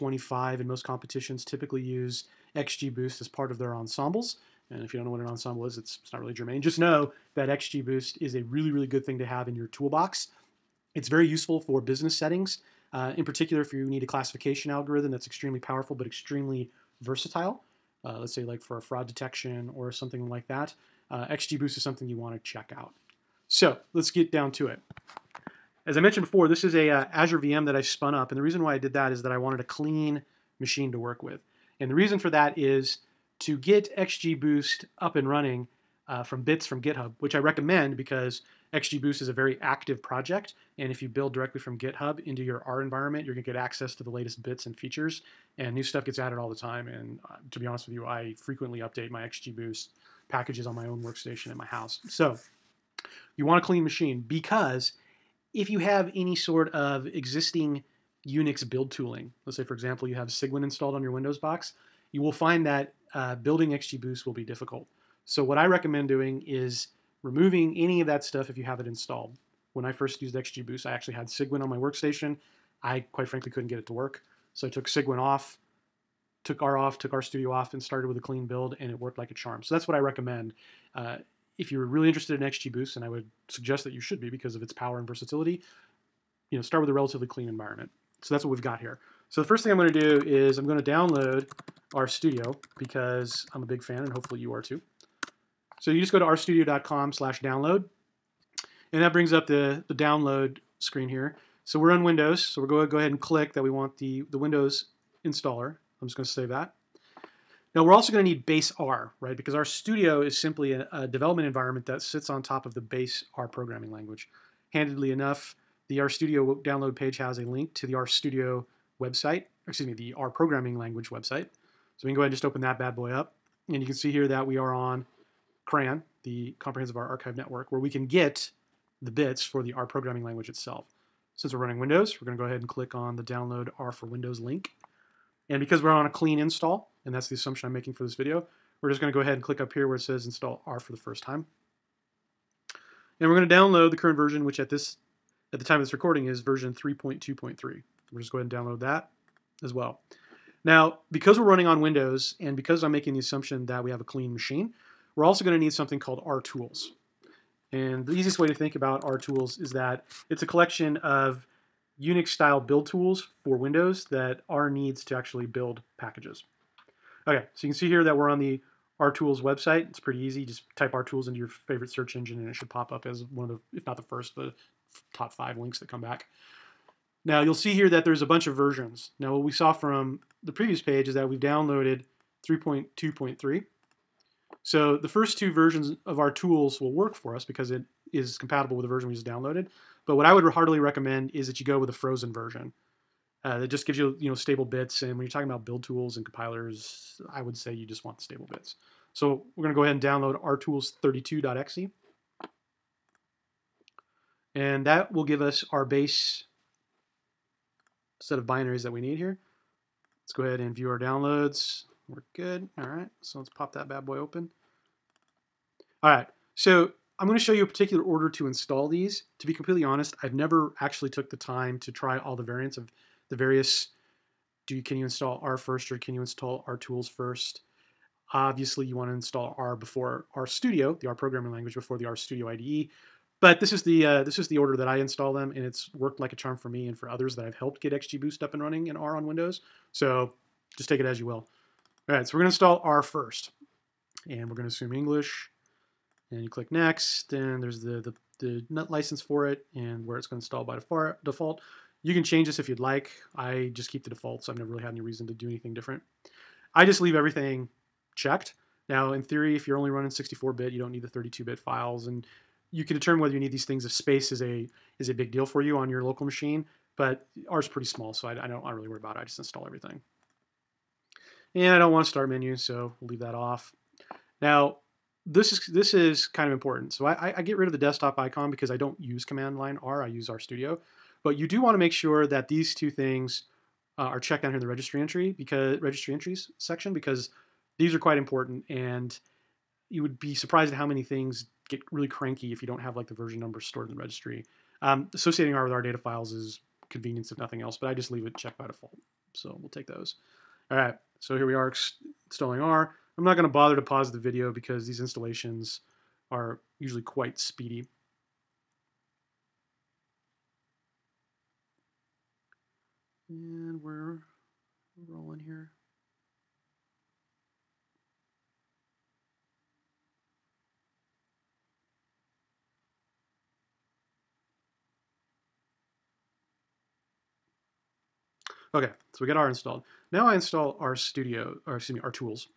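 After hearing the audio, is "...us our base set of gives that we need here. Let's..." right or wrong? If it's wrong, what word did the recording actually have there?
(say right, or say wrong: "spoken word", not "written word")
wrong: "binaries", not "gives".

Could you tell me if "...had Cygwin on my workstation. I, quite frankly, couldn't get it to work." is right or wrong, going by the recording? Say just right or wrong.
right.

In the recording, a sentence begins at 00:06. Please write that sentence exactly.
Just know that XGBoost is a really, really good thing to have in your toolbox.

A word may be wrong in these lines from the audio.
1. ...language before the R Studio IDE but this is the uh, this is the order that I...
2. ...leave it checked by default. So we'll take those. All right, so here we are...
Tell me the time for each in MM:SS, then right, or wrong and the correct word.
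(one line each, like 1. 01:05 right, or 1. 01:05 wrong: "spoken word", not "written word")
1. 03:51 right
2. 04:58 right.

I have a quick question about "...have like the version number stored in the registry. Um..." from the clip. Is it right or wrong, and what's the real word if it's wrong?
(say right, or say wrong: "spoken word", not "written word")
right.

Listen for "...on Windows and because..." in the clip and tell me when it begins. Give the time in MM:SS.
02:31.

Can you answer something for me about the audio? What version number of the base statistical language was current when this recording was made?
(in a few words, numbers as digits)
3.2.3.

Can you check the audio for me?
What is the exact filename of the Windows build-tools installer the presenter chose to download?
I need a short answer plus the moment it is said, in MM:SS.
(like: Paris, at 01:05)
rtools32.exe, at 03:20.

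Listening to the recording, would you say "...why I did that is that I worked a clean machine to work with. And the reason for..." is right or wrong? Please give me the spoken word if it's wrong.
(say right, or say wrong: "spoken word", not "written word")
wrong: "wanted", not "worked".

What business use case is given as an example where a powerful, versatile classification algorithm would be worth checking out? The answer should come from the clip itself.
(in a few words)
Fraud detection.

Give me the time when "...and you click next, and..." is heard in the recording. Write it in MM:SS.
04:06.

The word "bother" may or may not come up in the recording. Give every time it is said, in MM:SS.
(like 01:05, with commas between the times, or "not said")
05:03.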